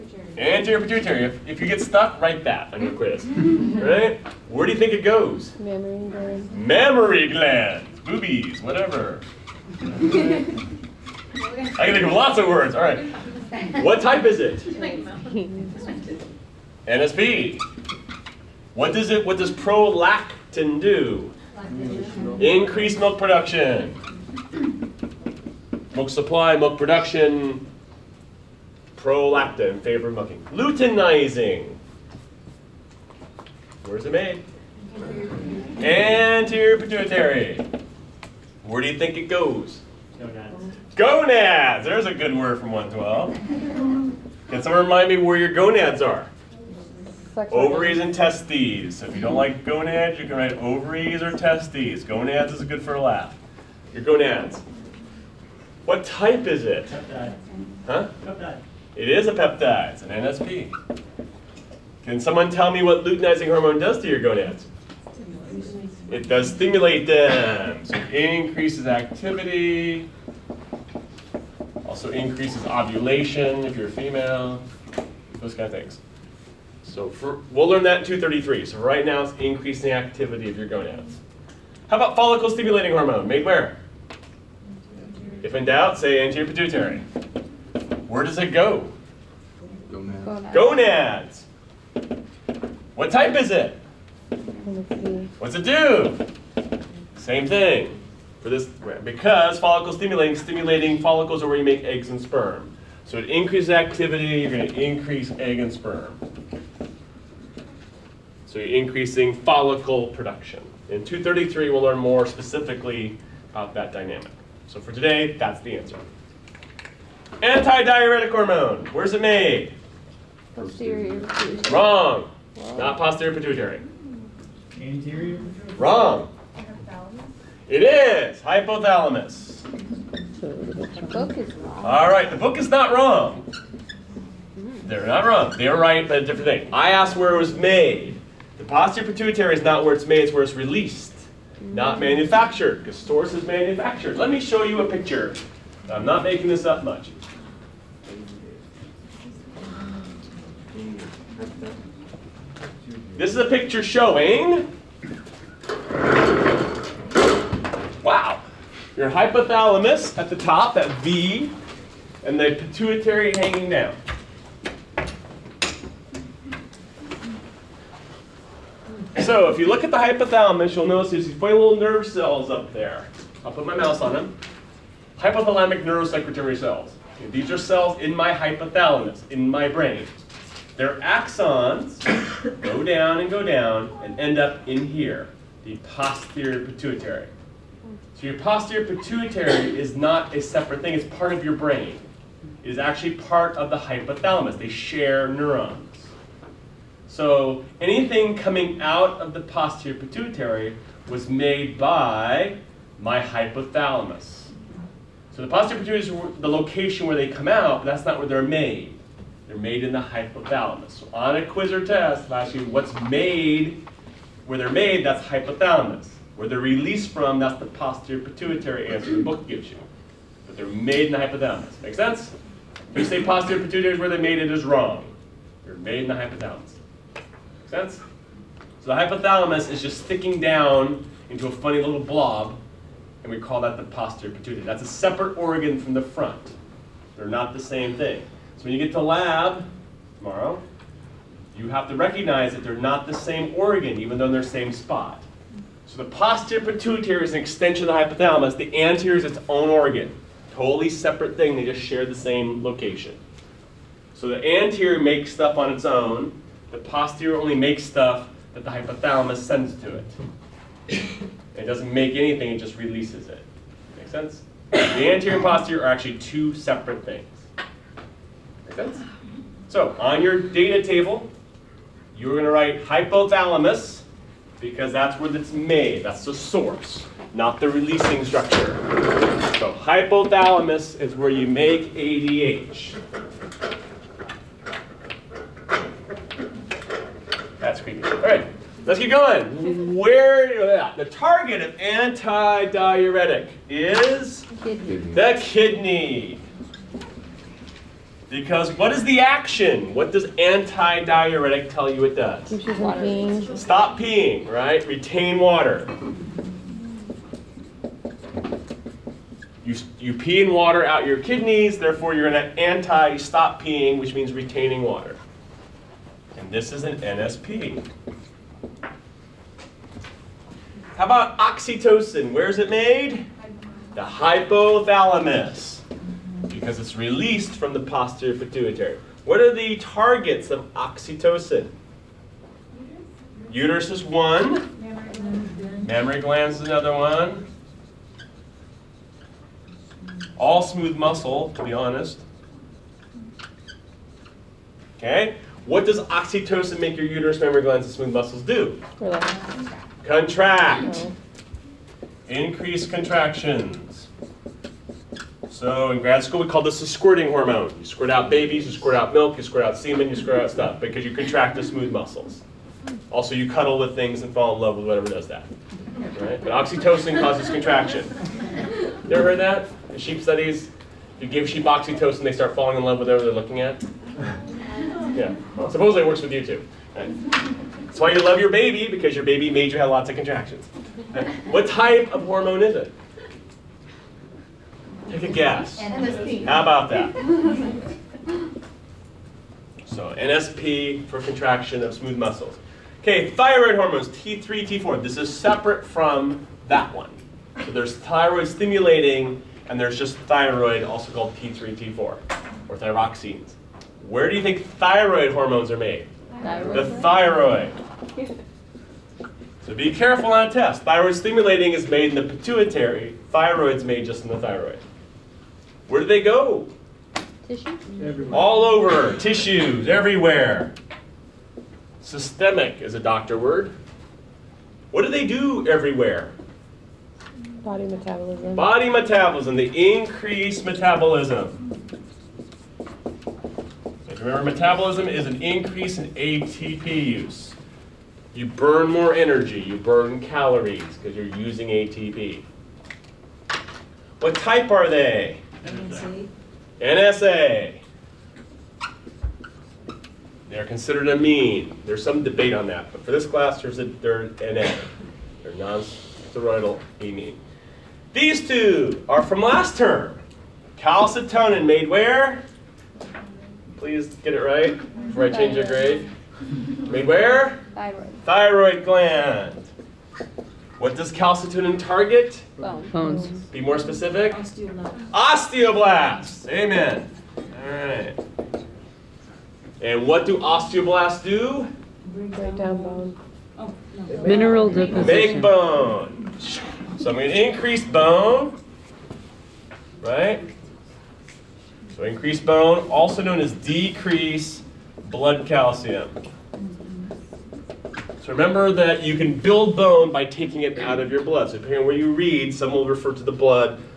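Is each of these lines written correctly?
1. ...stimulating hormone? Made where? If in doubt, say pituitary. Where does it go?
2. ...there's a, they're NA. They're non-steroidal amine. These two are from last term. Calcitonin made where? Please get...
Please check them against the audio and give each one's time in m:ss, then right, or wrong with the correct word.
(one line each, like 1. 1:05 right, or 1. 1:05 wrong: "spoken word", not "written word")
1. 1:22 right
2. 7:33 right.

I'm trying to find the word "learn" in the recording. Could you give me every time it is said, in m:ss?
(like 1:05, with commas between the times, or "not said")
1:17, 1:51.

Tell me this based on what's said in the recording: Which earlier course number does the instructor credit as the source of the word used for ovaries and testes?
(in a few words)
112.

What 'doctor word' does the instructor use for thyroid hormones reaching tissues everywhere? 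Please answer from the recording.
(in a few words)
Systemic.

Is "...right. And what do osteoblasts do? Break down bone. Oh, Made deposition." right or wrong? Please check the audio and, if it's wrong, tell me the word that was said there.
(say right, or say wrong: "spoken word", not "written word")
wrong: "Mineral", not "Made".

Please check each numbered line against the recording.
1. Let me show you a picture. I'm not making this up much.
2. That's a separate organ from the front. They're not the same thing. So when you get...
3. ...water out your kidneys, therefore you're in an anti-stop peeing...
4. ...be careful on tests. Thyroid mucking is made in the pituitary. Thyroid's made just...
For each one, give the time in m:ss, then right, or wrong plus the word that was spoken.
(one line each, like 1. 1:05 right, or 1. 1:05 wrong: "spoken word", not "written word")
1. 2:24 right
2. 3:54 right
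3. 5:10 right
4. 6:49 wrong: "stimulating", not "mucking".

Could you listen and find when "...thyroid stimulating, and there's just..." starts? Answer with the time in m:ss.
6:37.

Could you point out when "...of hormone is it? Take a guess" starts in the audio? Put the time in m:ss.
6:22.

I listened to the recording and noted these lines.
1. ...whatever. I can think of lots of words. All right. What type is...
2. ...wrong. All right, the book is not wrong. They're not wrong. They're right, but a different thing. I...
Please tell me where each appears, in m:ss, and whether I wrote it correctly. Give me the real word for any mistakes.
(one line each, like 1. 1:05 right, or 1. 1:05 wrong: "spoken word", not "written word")
1. 0:08 right
2. 2:11 right.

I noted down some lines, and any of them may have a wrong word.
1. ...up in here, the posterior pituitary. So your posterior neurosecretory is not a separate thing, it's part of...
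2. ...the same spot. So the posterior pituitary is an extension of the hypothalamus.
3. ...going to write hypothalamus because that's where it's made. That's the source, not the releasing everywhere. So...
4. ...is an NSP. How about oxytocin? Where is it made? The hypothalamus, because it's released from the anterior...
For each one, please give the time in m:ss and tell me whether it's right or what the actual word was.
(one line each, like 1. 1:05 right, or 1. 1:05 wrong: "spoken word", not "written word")
1. 3:04 wrong: "pituitary", not "neurosecretory"
2. 4:04 right
3. 4:32 wrong: "structure", not "everywhere"
4. 5:16 wrong: "posterior", not "anterior".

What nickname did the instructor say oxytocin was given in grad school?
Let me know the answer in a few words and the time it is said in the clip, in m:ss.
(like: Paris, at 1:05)
the squirting hormone, at 5:56.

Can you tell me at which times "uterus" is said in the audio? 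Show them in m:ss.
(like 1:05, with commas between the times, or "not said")
5:33, 5:47.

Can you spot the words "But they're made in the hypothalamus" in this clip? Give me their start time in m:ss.
3:40.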